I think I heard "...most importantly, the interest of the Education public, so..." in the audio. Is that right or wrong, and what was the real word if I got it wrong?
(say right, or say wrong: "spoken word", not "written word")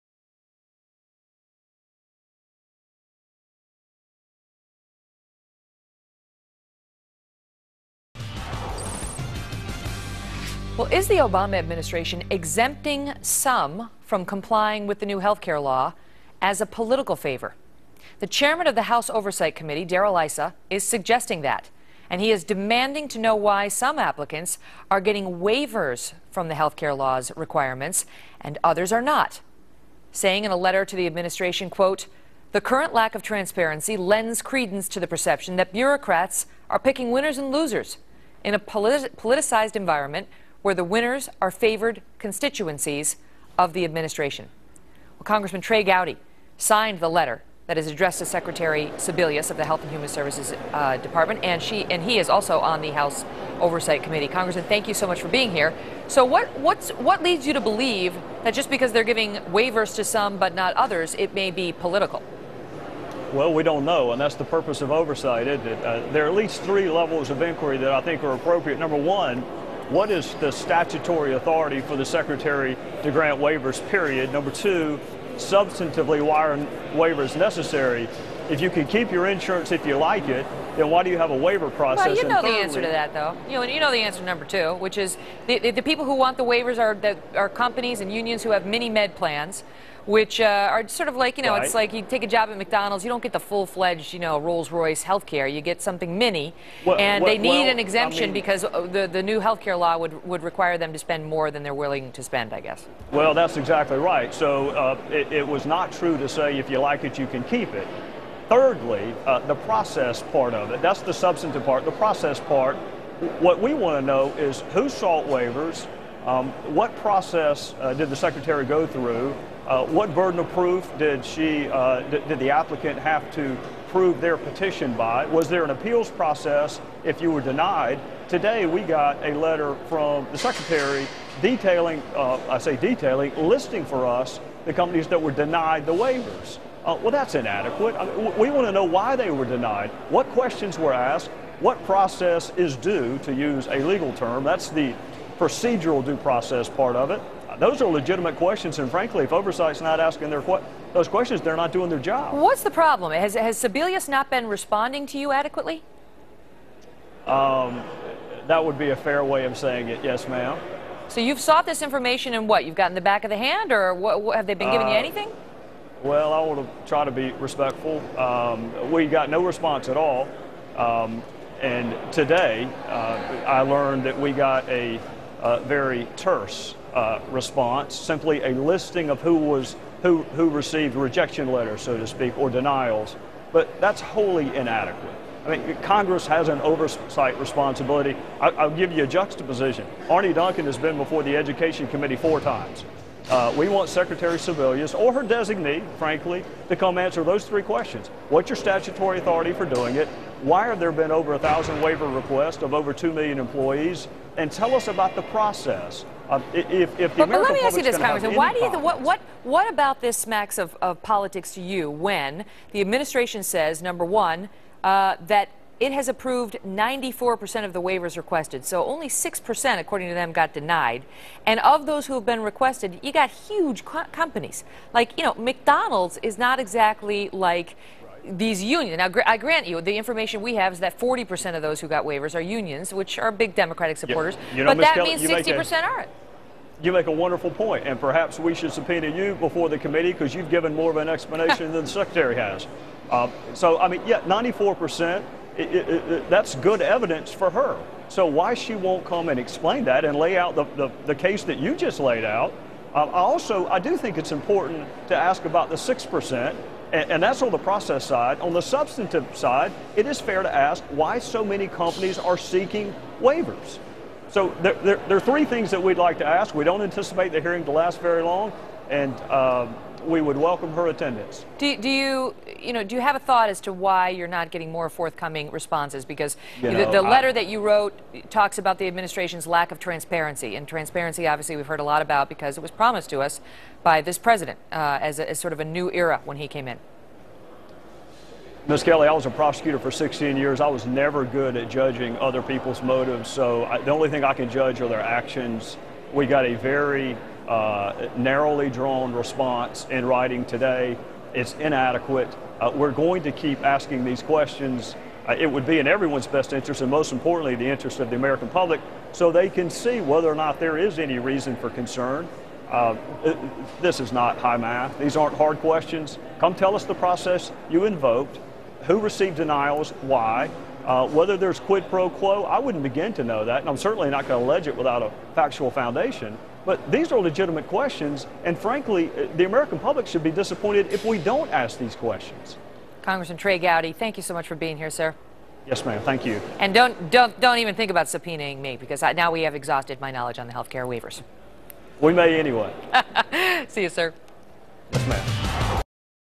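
wrong: "American", not "Education".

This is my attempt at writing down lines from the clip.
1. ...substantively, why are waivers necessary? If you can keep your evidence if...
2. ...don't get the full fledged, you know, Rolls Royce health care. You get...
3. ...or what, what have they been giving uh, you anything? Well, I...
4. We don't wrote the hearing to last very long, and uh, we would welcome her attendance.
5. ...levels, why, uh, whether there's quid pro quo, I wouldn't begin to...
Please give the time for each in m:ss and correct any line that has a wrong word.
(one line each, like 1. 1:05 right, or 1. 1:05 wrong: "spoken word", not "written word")
1. 1:15 wrong: "insurance", not "evidence"
2. 1:33 right
3. 2:43 right
4. 4:26 wrong: "anticipate", not "wrote"
5. 5:19 wrong: "denials", not "levels".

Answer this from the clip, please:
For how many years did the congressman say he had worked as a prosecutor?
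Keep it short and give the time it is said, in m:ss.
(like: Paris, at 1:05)
16, at 4:49.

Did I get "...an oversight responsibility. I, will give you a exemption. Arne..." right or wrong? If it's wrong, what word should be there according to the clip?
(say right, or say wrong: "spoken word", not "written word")
wrong: "juxtaposition", not "exemption".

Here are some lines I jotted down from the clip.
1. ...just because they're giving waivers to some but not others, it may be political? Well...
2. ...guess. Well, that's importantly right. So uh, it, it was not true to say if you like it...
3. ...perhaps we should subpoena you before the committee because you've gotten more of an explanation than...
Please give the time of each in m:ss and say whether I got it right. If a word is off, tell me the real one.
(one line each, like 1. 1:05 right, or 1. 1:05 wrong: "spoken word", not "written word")
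1. 0:58 right
2. 1:42 wrong: "exactly", not "importantly"
3. 3:57 wrong: "given", not "gotten".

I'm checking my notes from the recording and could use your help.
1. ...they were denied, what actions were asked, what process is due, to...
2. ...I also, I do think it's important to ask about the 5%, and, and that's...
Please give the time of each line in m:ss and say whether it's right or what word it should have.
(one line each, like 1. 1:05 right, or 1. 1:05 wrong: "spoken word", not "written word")
1. 2:19 wrong: "questions", not "actions"
2. 4:13 wrong: "6", not "5".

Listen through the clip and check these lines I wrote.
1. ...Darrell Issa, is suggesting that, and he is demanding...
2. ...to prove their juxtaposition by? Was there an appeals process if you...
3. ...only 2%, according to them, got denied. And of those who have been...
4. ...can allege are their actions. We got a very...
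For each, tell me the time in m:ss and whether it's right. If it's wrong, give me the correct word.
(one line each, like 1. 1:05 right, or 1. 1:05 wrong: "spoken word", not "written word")
1. 0:19 right
2. 2:03 wrong: "petition", not "juxtaposition"
3. 3:38 wrong: "6", not "2"
4. 4:54 wrong: "judge", not "allege".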